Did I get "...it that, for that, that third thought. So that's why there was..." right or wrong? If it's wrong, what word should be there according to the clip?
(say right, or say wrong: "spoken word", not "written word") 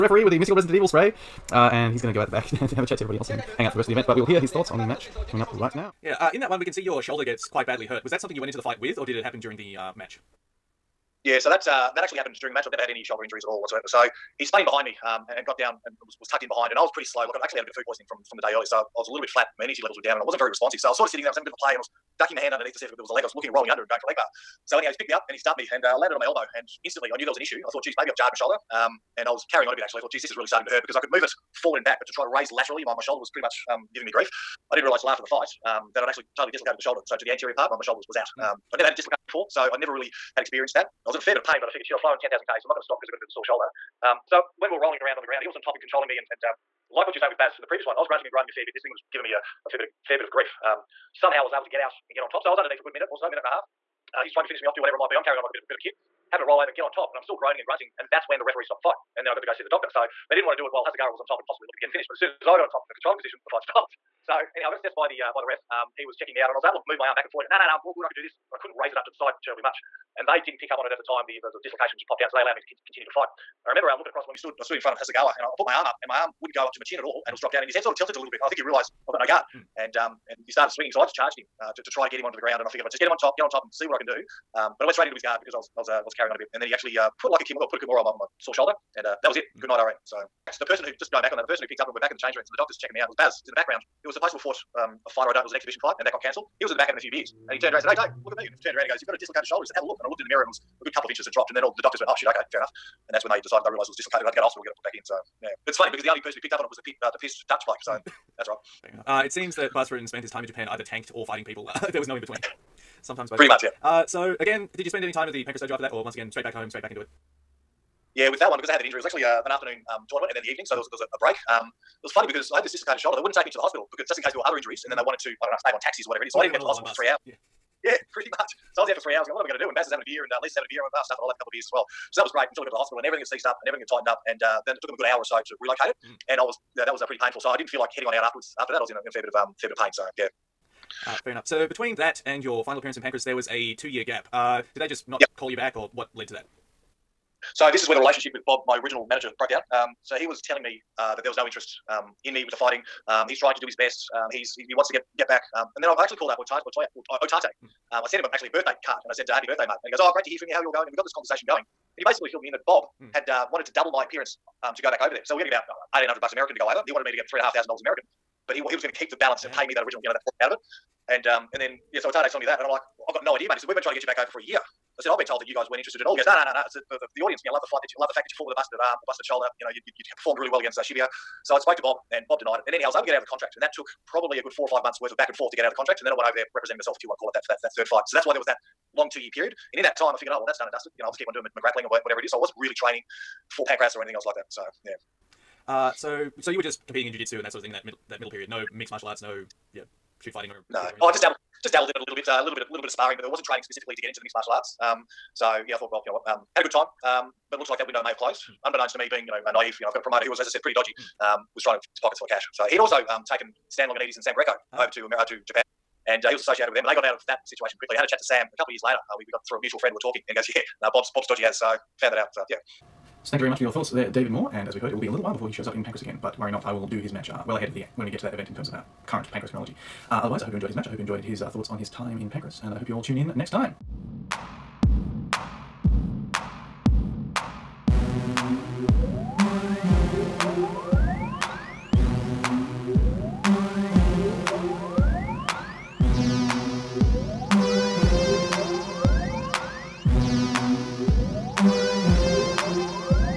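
wrong: "fight", not "thought".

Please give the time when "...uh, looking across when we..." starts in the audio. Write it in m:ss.
1:13.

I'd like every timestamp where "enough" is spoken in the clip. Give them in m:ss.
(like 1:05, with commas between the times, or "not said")
1:42, 1:48, 2:21.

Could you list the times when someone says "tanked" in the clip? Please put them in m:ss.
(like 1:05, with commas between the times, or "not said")
1:50.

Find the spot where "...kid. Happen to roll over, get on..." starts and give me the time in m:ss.
0:55.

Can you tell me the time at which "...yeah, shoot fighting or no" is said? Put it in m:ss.
3:19.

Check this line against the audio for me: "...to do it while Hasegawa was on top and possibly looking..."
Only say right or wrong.
right.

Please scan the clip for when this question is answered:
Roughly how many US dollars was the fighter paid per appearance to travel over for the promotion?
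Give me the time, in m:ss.
2:45.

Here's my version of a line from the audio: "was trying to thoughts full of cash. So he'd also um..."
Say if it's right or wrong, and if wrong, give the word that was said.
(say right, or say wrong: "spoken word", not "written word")
wrong: "pockets", not "thoughts".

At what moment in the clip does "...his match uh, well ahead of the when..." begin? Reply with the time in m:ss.
3:46.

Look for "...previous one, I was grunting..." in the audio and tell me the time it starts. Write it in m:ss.
0:47.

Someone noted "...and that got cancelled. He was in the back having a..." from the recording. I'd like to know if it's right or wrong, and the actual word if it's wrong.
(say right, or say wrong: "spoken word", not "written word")
right.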